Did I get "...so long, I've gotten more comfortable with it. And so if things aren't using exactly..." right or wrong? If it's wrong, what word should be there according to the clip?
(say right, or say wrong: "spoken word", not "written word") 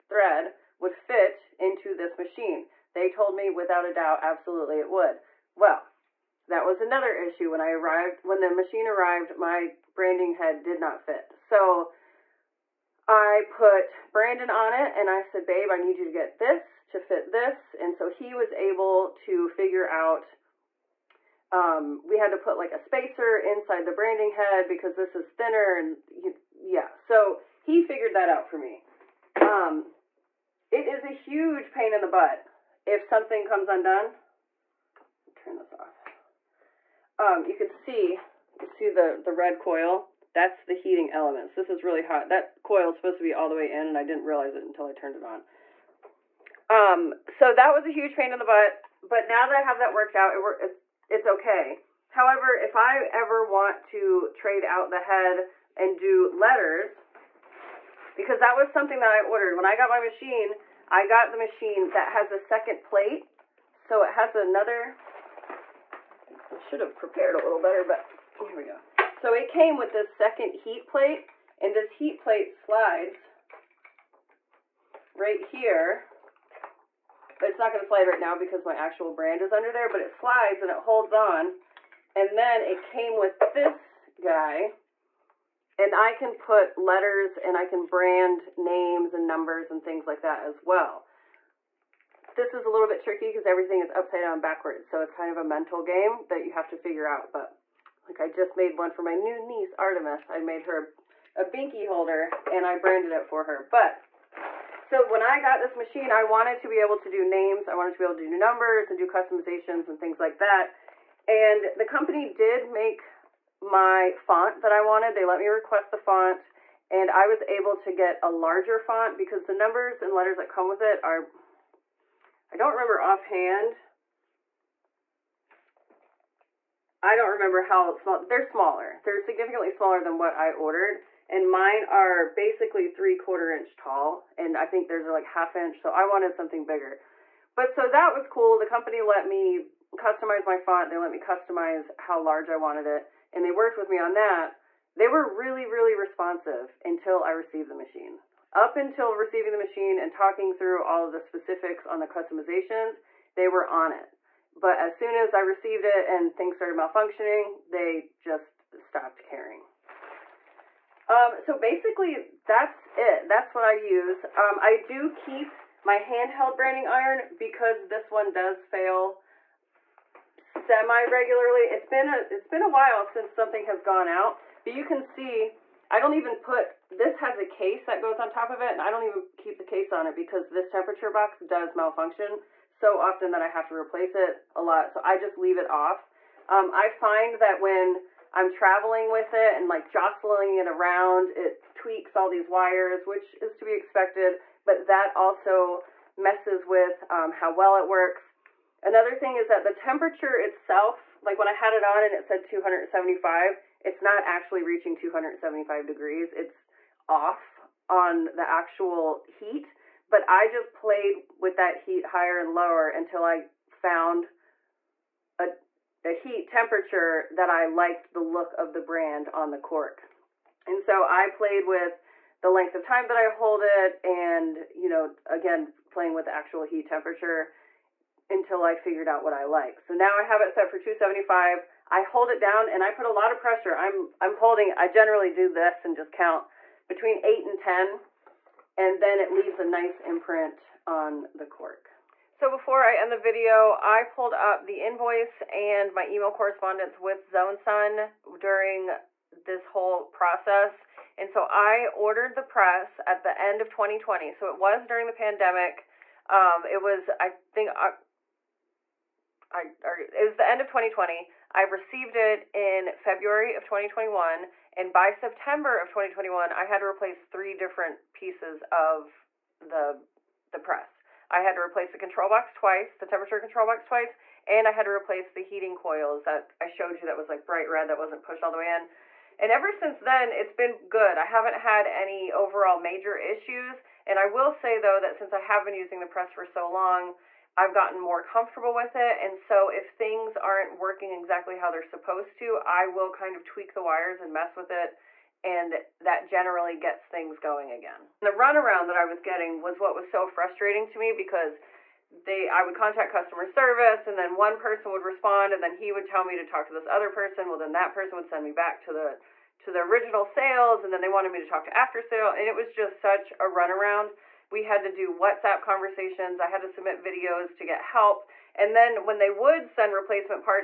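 wrong: "working", not "using".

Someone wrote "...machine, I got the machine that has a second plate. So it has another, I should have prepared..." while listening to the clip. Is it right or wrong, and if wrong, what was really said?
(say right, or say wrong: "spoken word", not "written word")
right.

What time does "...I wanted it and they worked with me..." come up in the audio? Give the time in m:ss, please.
2:22.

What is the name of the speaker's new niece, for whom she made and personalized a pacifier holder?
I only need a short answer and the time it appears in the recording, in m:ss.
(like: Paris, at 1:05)
Artemis, at 1:39.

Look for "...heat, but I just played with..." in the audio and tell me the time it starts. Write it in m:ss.
3:29.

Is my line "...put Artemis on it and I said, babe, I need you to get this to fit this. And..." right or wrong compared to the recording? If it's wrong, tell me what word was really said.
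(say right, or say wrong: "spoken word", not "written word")
wrong: "Brandon", not "Artemis".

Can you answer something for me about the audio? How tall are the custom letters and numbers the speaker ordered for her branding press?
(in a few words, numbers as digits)
3/4 inch.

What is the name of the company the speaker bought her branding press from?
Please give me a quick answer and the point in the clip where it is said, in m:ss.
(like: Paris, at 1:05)
ZoneSun, at 4:07.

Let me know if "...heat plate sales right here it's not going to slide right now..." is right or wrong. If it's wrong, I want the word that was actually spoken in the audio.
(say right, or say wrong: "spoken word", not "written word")
wrong: "slides", not "sales".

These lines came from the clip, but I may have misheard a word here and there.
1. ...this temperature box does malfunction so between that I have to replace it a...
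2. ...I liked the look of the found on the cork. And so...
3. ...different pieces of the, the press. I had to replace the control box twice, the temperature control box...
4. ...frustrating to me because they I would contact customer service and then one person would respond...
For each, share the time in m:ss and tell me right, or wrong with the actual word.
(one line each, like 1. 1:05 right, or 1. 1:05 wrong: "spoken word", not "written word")
1. 3:00 wrong: "often", not "between"
2. 3:37 wrong: "brand", not "found"
3. 4:27 right
4. 5:00 right.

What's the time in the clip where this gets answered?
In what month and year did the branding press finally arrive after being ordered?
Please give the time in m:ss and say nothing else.
4:22.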